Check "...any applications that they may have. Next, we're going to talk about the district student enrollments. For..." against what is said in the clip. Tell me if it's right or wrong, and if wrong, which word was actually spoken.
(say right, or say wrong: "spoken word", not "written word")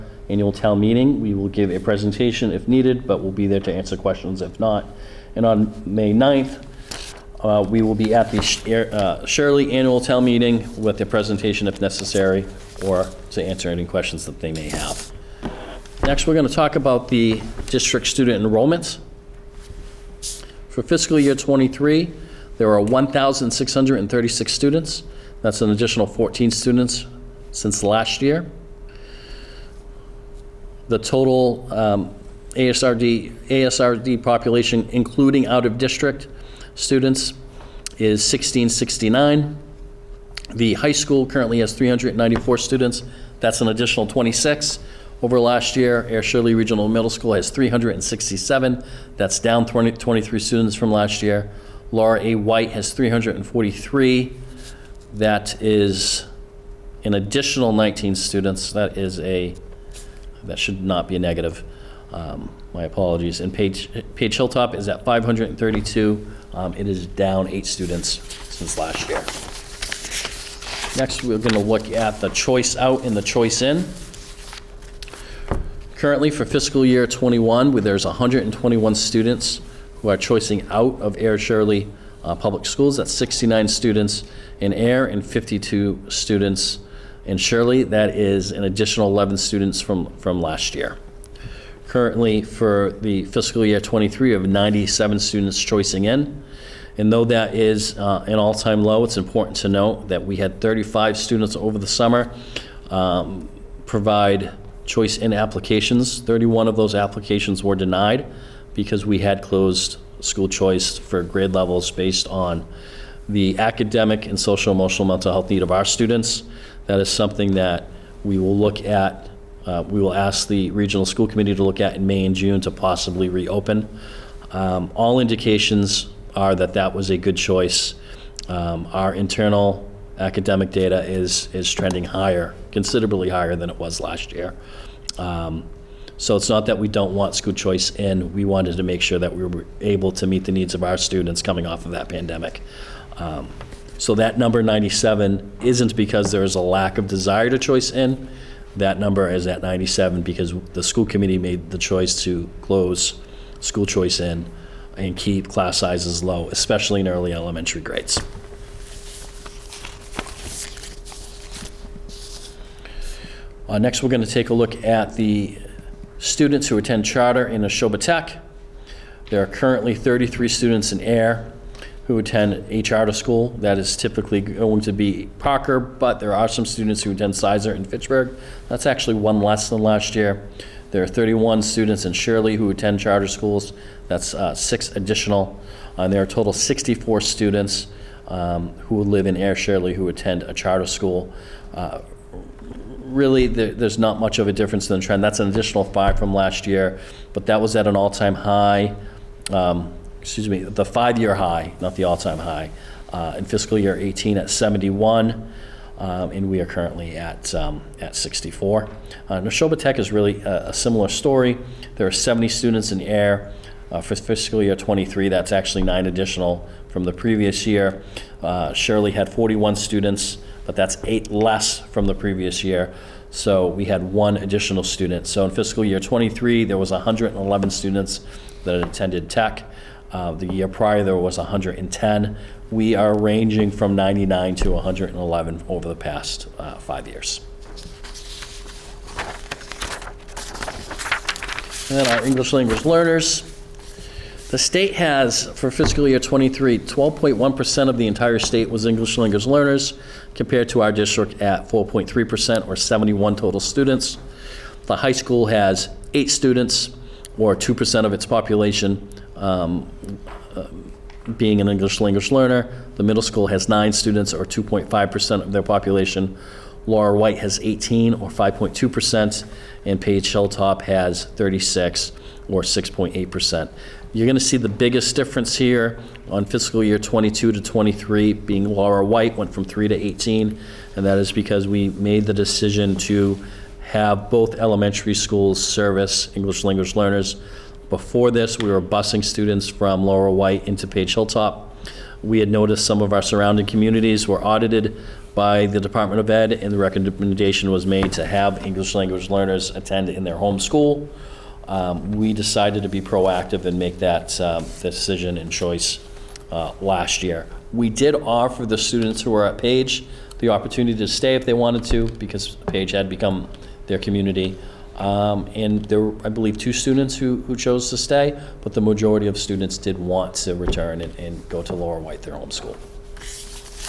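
wrong: "questions", not "applications".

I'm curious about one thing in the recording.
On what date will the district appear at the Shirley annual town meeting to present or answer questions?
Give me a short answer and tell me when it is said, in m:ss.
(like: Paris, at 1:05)
May 9, at 0:05.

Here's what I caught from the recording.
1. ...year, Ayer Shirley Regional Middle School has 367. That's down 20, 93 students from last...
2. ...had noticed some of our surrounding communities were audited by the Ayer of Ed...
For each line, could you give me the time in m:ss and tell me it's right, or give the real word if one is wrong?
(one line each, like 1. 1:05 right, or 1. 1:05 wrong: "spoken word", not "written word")
1. 0:45 wrong: "23", not "93"
2. 4:52 wrong: "Department", not "Ayer".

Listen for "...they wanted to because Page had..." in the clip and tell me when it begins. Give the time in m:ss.
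5:11.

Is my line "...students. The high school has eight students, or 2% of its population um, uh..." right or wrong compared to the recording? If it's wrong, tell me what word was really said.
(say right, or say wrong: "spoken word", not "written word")
right.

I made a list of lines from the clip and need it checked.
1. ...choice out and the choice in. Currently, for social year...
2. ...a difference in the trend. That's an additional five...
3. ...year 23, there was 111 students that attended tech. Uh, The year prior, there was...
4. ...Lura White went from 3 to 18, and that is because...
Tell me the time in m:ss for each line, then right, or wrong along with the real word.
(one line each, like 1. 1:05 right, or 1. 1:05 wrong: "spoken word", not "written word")
1. 1:12 wrong: "fiscal", not "social"
2. 3:14 right
3. 3:45 right
4. 4:38 right.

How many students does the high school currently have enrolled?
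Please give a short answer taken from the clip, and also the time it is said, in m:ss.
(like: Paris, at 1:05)
394, at 0:41.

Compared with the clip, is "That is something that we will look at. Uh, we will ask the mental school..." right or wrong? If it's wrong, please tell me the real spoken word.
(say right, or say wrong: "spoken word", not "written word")
wrong: "regional", not "mental".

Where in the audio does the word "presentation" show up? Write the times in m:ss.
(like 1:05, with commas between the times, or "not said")
0:01, 0:11.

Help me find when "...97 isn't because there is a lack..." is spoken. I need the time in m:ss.
2:24.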